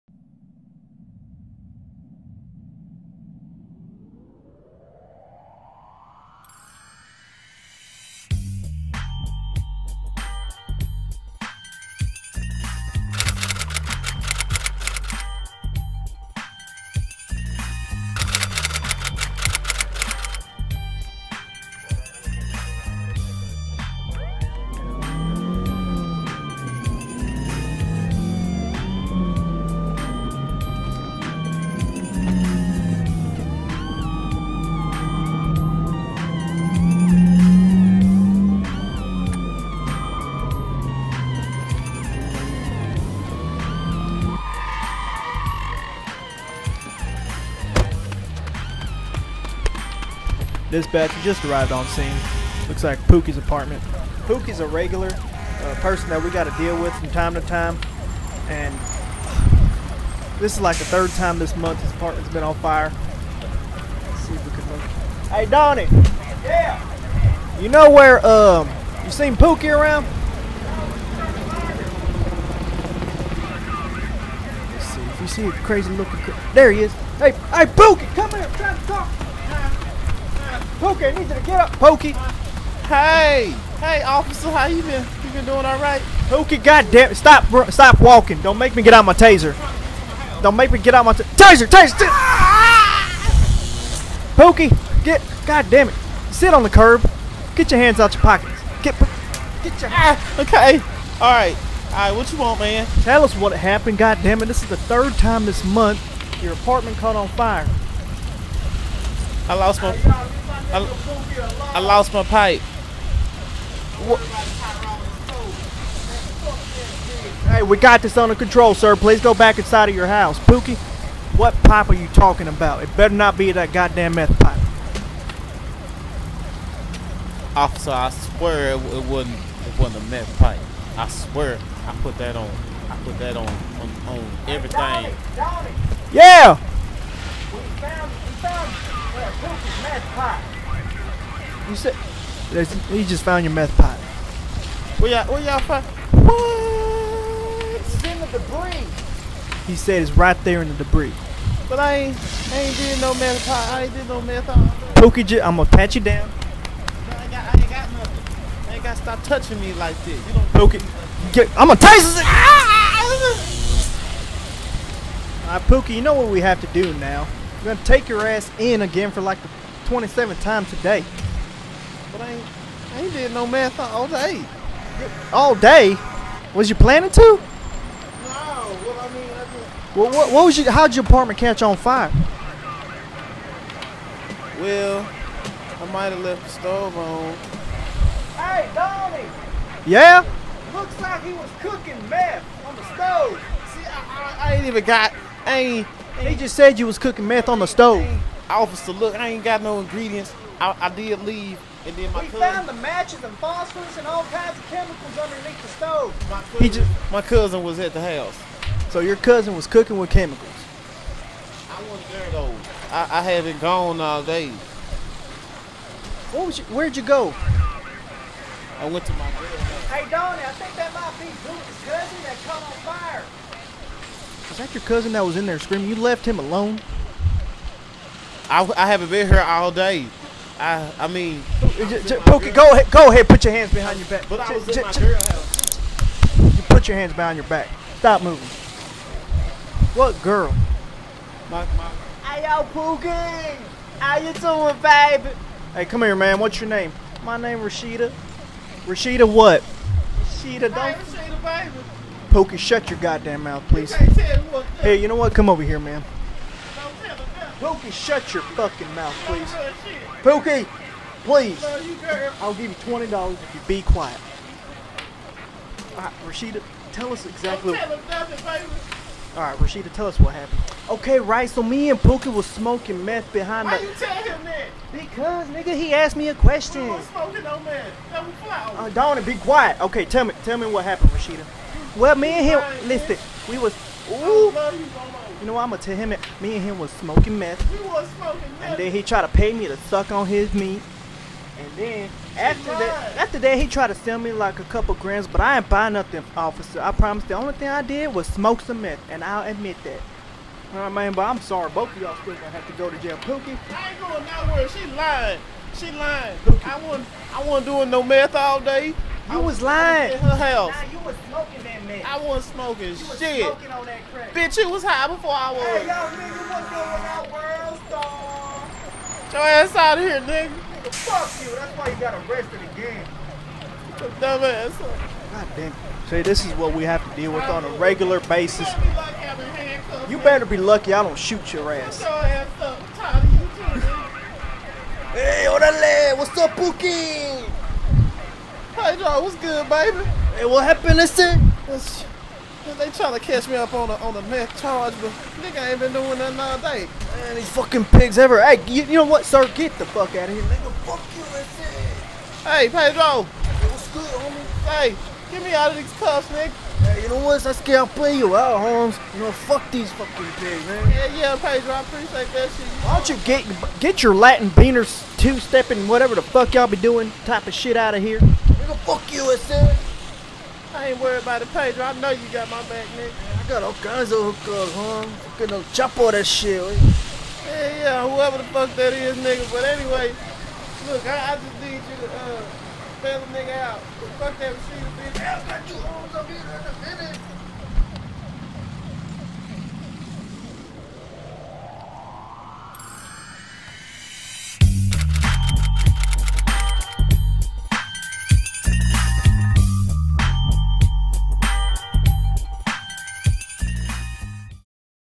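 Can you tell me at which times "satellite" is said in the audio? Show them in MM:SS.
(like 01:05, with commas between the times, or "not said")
not said.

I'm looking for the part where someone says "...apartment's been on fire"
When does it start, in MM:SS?
01:01.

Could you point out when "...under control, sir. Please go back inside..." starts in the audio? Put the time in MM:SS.
01:58.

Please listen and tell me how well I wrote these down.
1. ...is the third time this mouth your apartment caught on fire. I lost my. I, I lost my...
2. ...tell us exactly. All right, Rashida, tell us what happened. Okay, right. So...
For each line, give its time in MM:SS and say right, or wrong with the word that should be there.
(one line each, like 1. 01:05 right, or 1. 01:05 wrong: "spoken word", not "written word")
1. 01:44 wrong: "month", not "mouth"
2. 04:26 right.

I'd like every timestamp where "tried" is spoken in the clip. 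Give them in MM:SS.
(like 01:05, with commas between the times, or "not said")
04:49, 04:53.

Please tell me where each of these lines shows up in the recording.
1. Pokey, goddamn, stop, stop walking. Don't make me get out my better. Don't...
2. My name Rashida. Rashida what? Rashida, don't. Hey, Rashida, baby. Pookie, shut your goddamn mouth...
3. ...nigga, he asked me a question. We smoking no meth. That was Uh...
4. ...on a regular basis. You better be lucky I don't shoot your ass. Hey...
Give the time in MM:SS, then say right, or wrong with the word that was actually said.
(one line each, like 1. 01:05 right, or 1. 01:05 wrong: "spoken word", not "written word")
1. 01:26 wrong: "taser", not "better"
2. 04:07 right
3. 04:35 right
4. 05:27 right.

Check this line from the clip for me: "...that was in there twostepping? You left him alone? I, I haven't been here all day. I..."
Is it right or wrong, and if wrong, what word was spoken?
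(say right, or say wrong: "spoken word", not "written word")
wrong: "screaming", not "twostepping".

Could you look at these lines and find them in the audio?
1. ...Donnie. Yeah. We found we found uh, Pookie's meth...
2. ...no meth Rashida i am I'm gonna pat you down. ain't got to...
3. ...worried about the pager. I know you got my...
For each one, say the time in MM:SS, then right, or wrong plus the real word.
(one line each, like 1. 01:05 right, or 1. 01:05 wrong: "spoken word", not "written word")
1. 02:15 right
2. 02:34 wrong: "Pookie", not "Rashida"
3. 06:11 right.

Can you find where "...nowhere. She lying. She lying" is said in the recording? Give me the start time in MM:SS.
05:04.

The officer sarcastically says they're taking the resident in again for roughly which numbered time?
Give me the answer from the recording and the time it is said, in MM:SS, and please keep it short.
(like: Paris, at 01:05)
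27th, at 02:49.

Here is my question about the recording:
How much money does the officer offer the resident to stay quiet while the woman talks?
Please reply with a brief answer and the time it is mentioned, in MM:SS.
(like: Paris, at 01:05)
$20, at 04:22.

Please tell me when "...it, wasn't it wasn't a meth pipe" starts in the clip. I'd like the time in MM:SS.
02:08.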